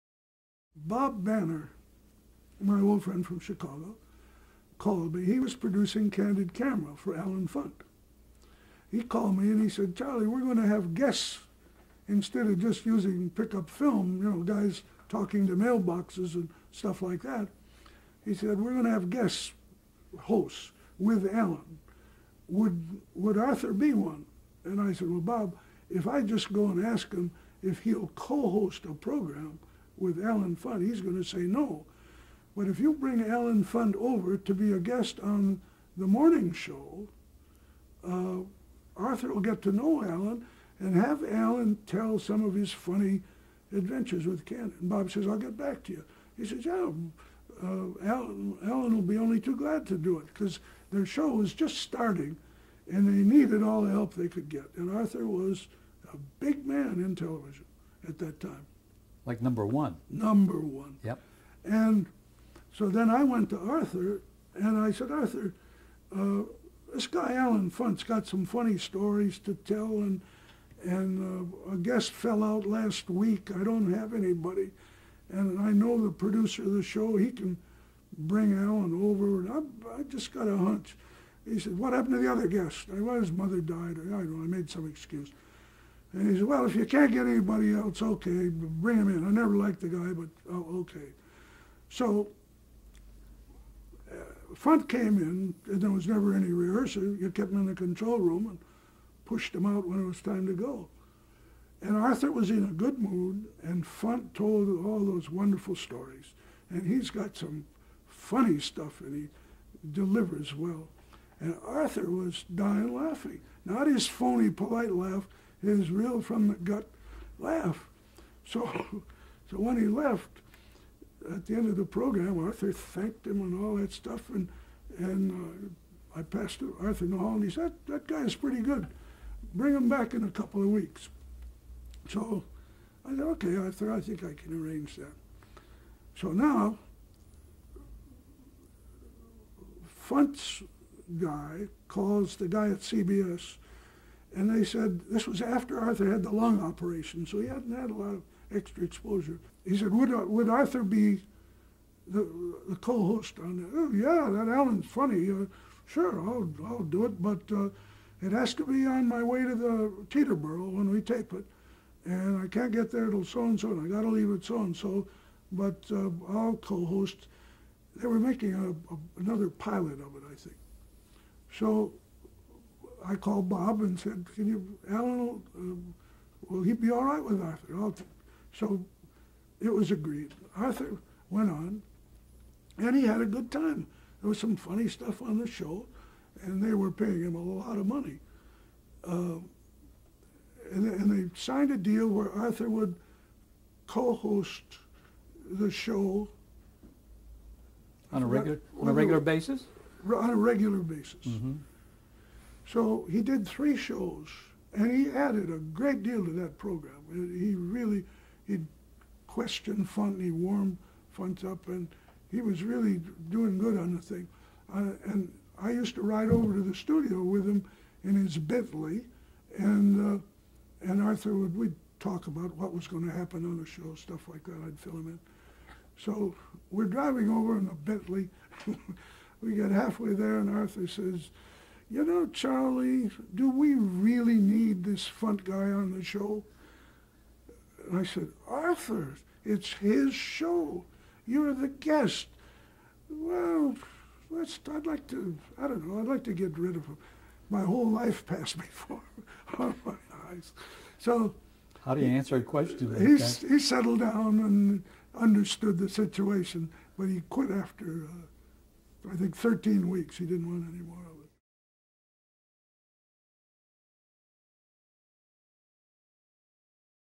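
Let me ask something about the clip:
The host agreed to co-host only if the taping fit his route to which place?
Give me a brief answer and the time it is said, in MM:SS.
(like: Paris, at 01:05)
Teterboro, at 02:40.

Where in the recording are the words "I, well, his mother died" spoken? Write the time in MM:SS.
01:22.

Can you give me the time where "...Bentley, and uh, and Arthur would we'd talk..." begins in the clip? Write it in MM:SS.
03:38.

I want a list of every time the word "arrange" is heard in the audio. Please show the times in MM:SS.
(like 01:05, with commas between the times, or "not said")
02:14.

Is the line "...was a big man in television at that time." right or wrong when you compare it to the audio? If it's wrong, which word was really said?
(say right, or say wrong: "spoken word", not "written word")
right.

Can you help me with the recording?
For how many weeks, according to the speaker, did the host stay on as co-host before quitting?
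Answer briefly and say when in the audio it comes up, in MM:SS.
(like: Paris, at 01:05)
13, at 04:19.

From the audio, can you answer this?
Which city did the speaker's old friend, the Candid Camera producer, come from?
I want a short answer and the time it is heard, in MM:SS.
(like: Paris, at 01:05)
Chicago, at 00:03.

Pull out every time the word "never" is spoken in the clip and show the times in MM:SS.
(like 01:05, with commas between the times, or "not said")
01:29, 01:36.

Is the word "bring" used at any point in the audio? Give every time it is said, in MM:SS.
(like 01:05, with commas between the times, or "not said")
00:32, 01:18, 01:28, 02:09.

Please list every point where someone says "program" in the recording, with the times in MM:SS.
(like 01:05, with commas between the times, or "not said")
00:28, 02:01, 03:26.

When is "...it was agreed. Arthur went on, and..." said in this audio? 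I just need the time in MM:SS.
02:59.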